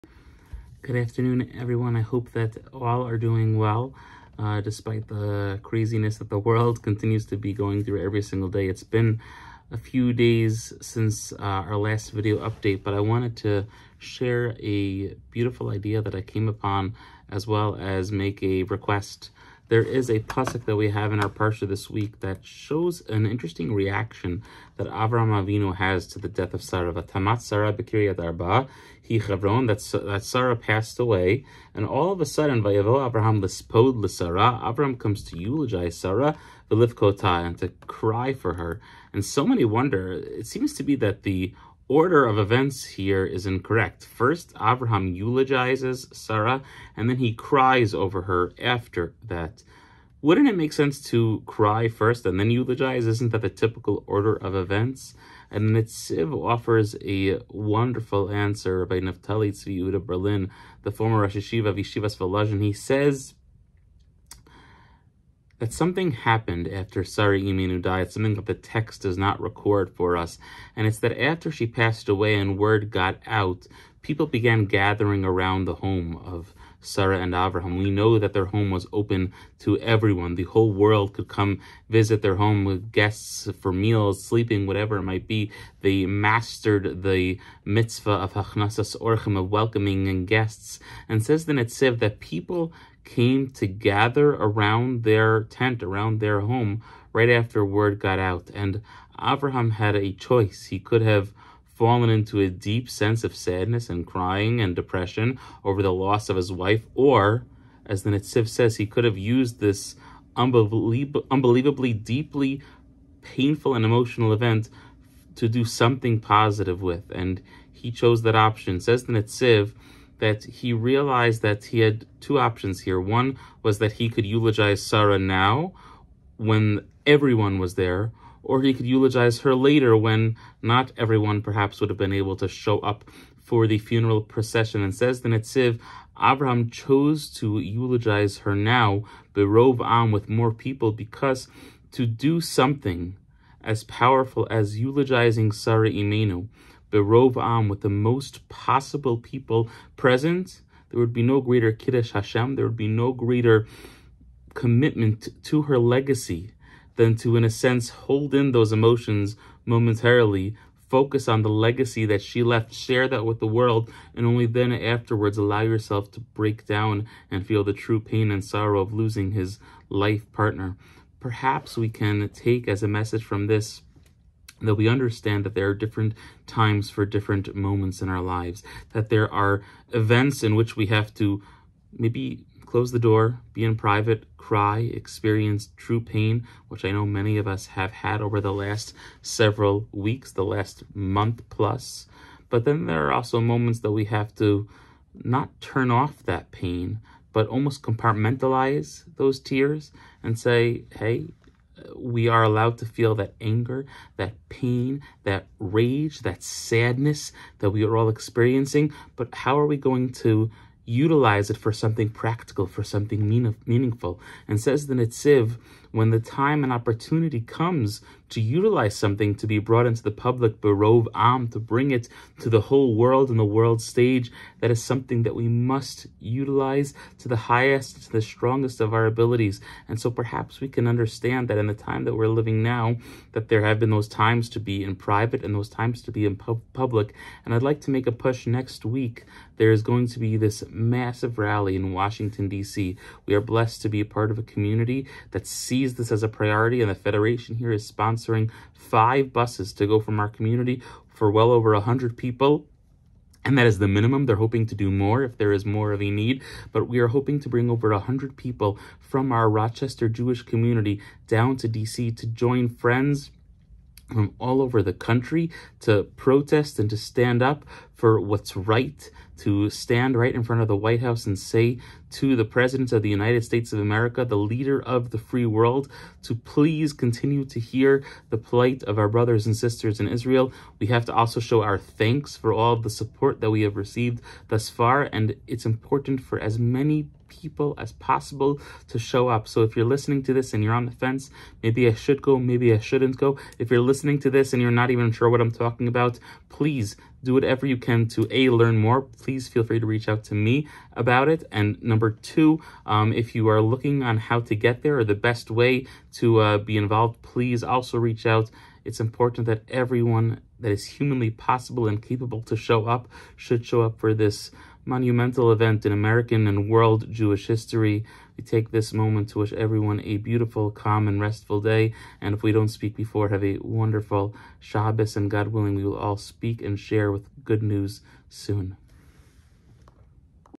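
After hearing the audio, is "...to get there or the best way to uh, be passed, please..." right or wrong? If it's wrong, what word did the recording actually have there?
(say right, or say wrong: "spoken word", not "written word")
wrong: "involved", not "passed".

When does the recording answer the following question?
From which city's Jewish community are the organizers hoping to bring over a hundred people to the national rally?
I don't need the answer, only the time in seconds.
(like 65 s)
259 s.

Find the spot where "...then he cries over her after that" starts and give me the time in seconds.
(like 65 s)
47 s.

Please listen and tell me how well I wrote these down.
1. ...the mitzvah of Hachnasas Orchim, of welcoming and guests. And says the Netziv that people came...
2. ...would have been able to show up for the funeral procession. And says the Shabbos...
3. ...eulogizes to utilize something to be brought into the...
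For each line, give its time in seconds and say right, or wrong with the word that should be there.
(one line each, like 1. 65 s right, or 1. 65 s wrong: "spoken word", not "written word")
1. 87 s right
2. 131 s wrong: "Netziv", not "Shabbos"
3. 217 s wrong: "comes", not "eulogizes".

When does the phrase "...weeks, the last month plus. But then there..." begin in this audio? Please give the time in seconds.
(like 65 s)
189 s.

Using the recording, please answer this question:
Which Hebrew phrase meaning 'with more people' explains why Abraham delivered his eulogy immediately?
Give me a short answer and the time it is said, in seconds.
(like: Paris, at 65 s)
berov am, at 139 s.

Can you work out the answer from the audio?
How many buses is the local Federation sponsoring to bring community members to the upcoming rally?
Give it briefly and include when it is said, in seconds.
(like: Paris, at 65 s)
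5, at 248 s.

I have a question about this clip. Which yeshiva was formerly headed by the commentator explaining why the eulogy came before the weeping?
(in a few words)
Volozhin.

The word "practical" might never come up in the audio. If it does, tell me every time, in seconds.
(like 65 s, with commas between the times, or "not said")
212 s.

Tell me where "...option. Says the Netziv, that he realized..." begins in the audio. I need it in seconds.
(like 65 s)
118 s.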